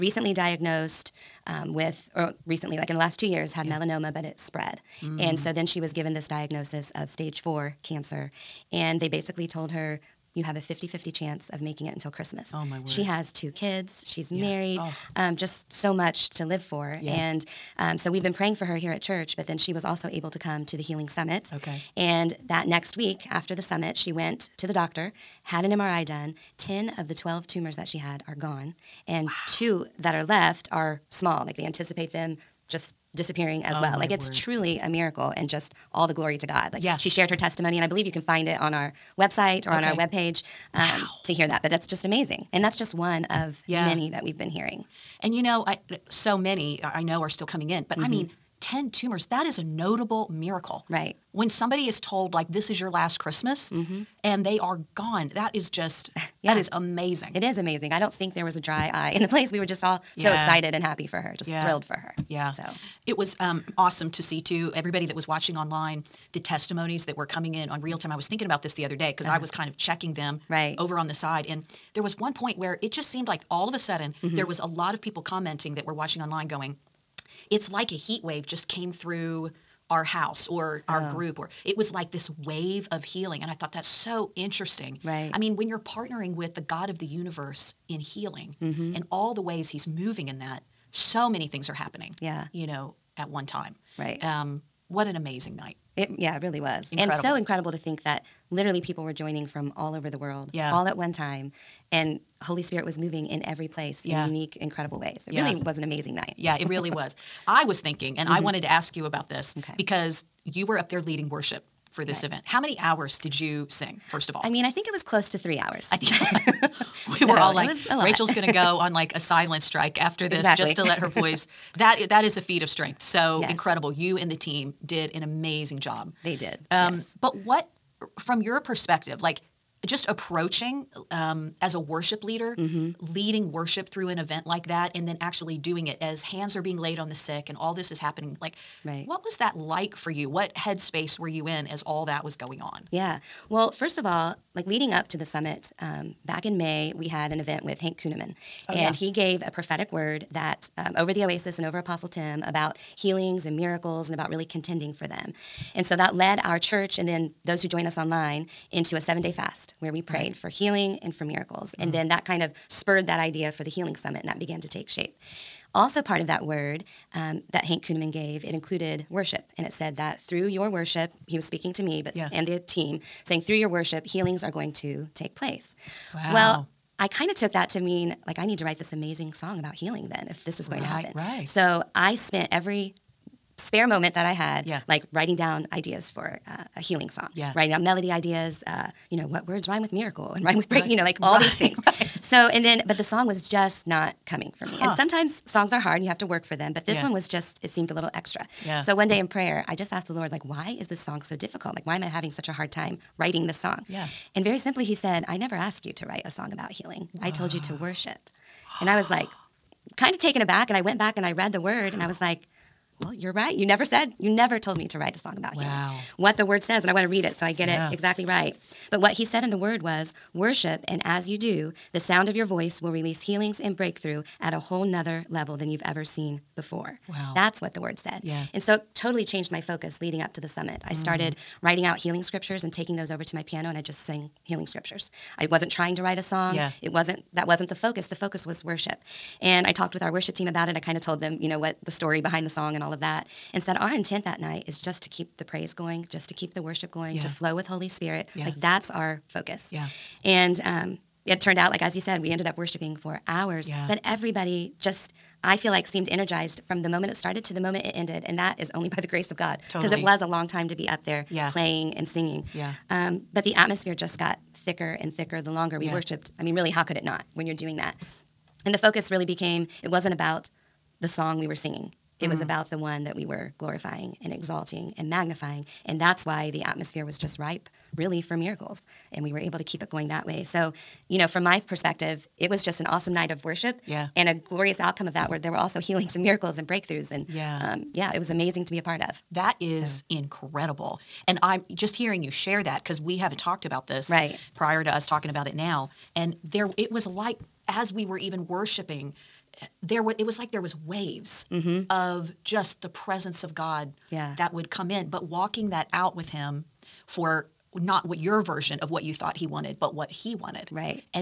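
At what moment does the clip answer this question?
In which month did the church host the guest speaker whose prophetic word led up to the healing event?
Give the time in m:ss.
2:26.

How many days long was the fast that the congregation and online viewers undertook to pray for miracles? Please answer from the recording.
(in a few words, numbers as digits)
7.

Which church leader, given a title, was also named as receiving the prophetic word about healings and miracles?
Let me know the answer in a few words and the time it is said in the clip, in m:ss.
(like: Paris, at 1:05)
Apostle Tim, at 2:31.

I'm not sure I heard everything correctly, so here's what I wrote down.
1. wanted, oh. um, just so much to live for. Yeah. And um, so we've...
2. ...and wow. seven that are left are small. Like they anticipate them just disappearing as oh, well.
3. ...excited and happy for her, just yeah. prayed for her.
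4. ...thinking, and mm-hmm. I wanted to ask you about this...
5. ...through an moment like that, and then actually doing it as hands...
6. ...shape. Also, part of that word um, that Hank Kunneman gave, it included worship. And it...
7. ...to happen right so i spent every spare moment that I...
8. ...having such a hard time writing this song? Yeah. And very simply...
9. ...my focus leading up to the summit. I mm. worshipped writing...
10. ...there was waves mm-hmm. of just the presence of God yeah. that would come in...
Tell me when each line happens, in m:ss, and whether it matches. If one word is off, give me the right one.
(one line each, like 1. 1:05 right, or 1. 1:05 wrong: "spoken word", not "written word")
1. 0:14 wrong: "married", not "wanted"
2. 0:29 wrong: "two", not "seven"
3. 1:00 wrong: "thrilled", not "prayed"
4. 1:47 right
5. 2:13 wrong: "event", not "moment"
6. 2:44 right
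7. 3:00 right
8. 3:22 right
9. 3:49 wrong: "started", not "worshipped"
10. 5:00 right.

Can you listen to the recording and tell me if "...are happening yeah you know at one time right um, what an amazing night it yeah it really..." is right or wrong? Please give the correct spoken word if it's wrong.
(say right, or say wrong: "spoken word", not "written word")
right.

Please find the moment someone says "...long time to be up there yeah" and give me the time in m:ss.
4:20.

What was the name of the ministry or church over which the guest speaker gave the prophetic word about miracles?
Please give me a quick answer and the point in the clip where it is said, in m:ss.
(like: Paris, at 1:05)
the Oasis, at 2:31.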